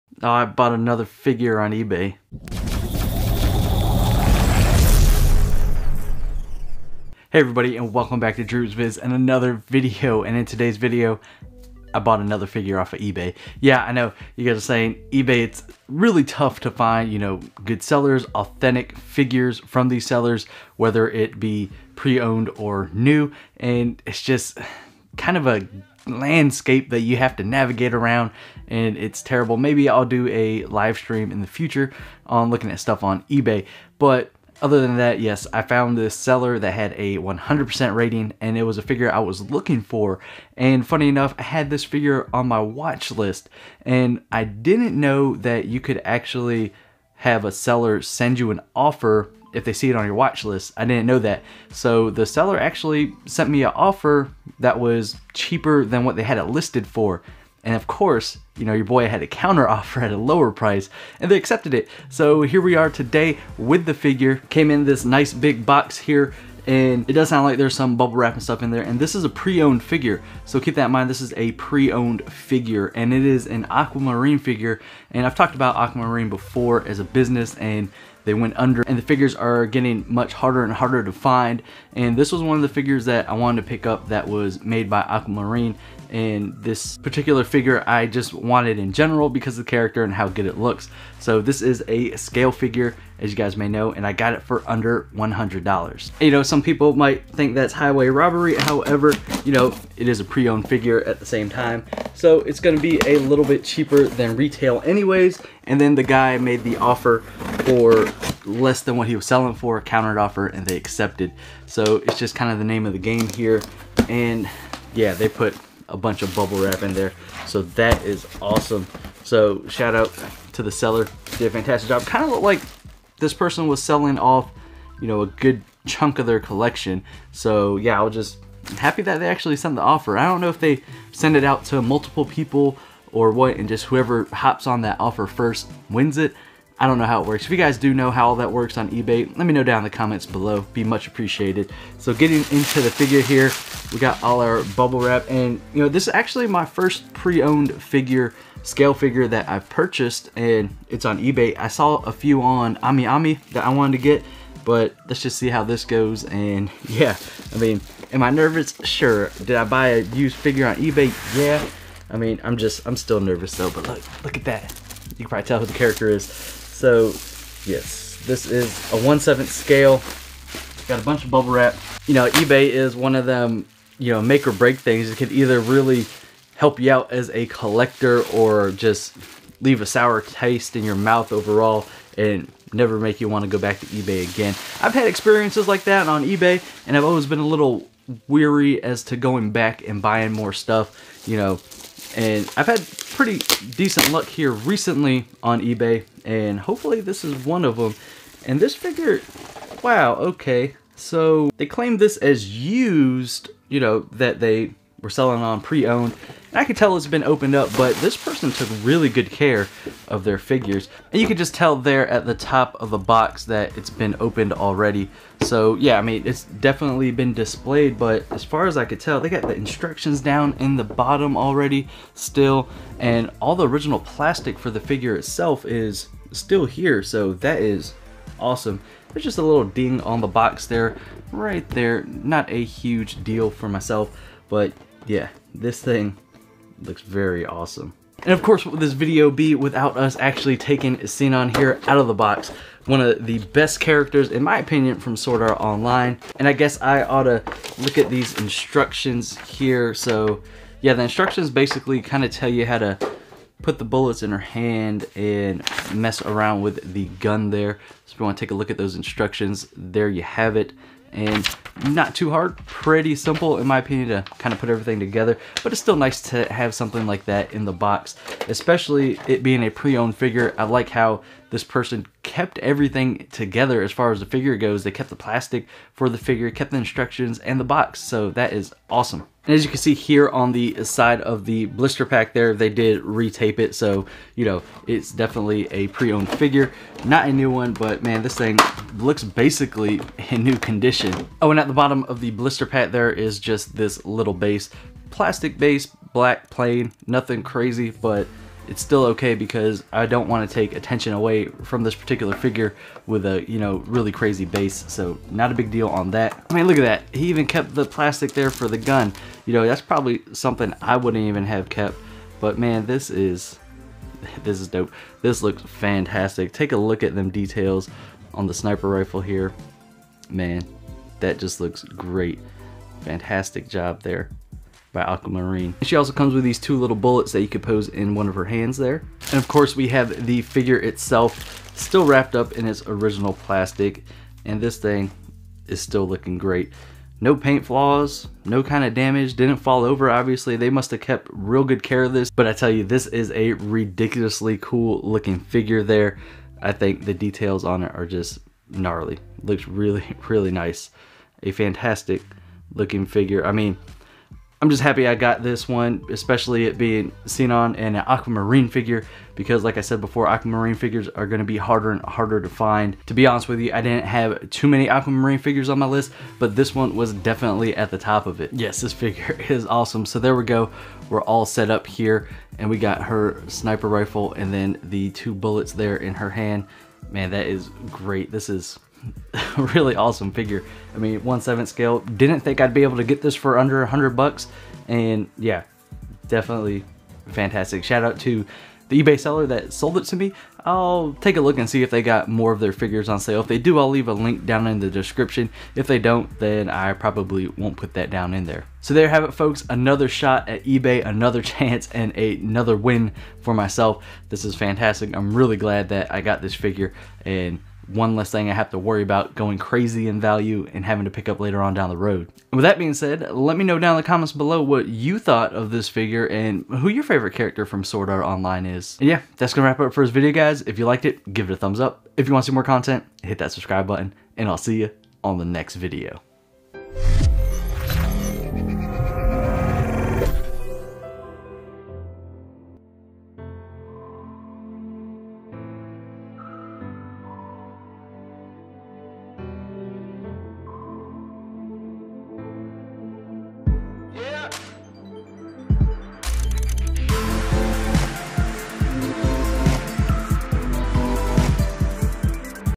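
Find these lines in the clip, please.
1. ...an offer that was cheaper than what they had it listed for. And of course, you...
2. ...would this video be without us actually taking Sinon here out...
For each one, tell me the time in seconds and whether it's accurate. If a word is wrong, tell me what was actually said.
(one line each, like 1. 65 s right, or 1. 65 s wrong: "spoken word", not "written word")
1. 53 s right
2. 238 s right.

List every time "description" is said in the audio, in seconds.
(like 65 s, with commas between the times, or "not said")
394 s.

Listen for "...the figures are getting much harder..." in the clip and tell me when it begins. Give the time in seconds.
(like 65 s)
78 s.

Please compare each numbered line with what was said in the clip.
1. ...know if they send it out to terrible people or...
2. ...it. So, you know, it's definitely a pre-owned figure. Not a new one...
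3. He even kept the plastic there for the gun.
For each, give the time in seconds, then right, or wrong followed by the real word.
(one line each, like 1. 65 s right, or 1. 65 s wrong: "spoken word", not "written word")
1. 130 s wrong: "multiple", not "terrible"
2. 283 s right
3. 307 s right.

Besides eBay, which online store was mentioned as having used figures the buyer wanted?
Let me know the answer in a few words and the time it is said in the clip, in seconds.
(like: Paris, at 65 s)
Ami Ami, at 152 s.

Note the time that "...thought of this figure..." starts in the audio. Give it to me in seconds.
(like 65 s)
415 s.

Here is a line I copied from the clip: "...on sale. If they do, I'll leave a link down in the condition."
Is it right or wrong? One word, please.
wrong.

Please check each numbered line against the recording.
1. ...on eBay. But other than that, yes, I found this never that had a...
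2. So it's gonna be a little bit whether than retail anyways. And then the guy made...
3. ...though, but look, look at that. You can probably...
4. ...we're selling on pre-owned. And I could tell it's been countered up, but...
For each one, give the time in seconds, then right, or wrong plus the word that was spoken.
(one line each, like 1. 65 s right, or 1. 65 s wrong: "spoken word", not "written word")
1. 33 s wrong: "seller", not "never"
2. 102 s wrong: "cheaper", not "whether"
3. 163 s right
4. 205 s wrong: "opened", not "countered".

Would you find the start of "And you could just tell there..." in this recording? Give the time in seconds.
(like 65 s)
211 s.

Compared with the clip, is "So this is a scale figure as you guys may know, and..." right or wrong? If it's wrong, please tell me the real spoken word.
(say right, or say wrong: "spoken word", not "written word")
right.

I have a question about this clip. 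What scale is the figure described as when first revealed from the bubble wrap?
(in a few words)
1/7.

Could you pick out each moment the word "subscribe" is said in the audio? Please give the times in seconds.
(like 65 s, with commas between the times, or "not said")
423 s.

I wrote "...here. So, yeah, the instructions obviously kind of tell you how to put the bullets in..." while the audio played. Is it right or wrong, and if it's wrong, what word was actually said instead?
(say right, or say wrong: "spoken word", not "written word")
wrong: "basically", not "obviously".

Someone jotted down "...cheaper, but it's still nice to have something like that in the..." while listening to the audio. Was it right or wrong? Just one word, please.
wrong.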